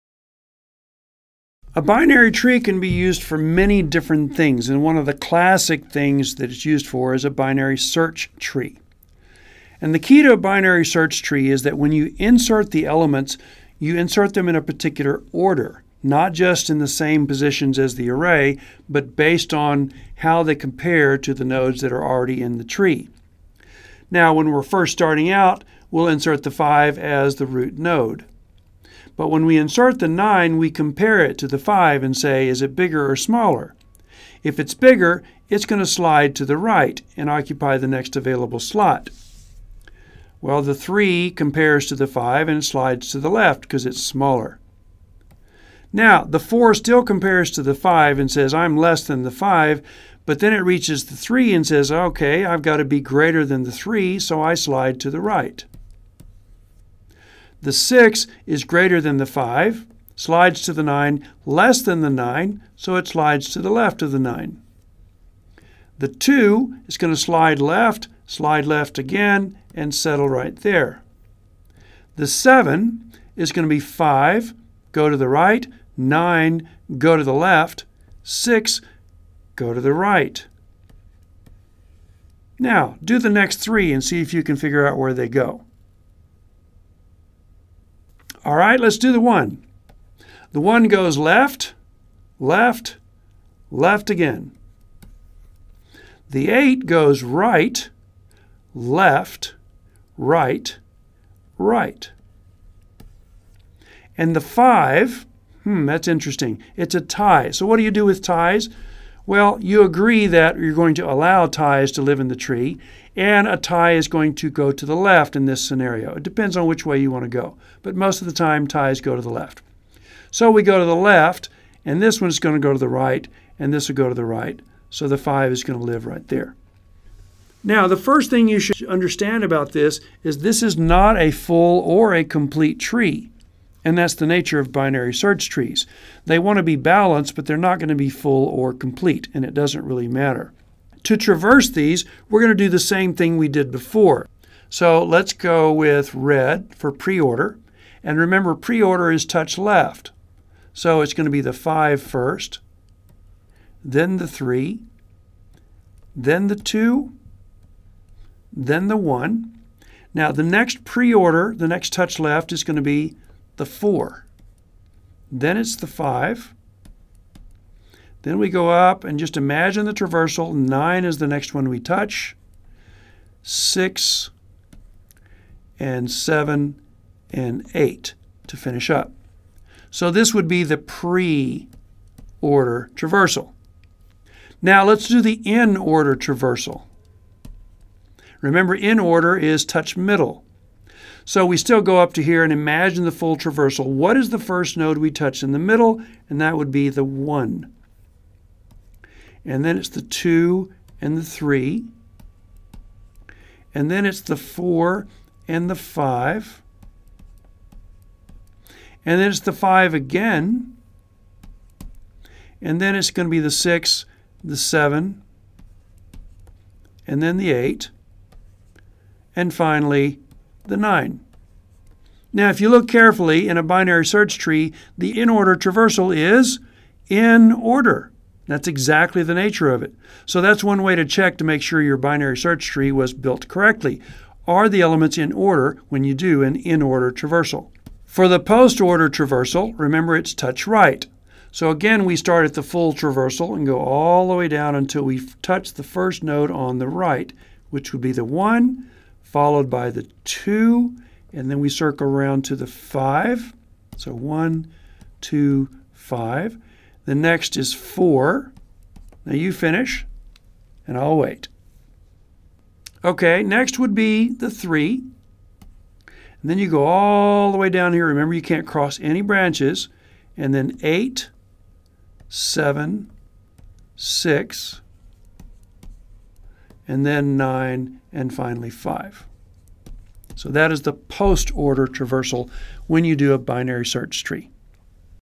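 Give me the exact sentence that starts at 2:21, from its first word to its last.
To traverse these, we're going to do the same thing we did before.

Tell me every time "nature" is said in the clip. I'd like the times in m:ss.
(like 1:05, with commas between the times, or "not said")
2:14, 3:49.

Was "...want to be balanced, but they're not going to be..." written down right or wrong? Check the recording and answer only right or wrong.
right.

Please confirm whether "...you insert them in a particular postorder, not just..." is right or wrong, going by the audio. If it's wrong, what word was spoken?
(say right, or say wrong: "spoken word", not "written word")
wrong: "order", not "postorder".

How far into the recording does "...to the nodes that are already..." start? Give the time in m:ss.
0:21.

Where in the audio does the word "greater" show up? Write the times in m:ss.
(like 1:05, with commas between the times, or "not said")
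0:52, 0:58.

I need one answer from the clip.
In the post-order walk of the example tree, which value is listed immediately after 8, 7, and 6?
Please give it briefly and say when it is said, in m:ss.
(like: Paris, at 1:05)
9, at 4:36.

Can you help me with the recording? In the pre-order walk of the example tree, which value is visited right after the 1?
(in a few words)
4.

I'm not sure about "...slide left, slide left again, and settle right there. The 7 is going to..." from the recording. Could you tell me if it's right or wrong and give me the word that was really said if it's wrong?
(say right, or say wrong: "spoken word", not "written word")
right.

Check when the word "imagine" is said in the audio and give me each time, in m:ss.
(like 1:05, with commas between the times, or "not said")
2:49, 3:12.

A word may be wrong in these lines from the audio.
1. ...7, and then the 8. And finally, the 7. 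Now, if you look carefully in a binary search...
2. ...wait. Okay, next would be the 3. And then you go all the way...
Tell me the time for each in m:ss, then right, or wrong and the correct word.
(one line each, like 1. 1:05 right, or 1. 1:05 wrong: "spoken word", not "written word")
1. 3:34 wrong: "9", not "7"
2. 4:21 right.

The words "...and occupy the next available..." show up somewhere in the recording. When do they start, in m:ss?
0:37.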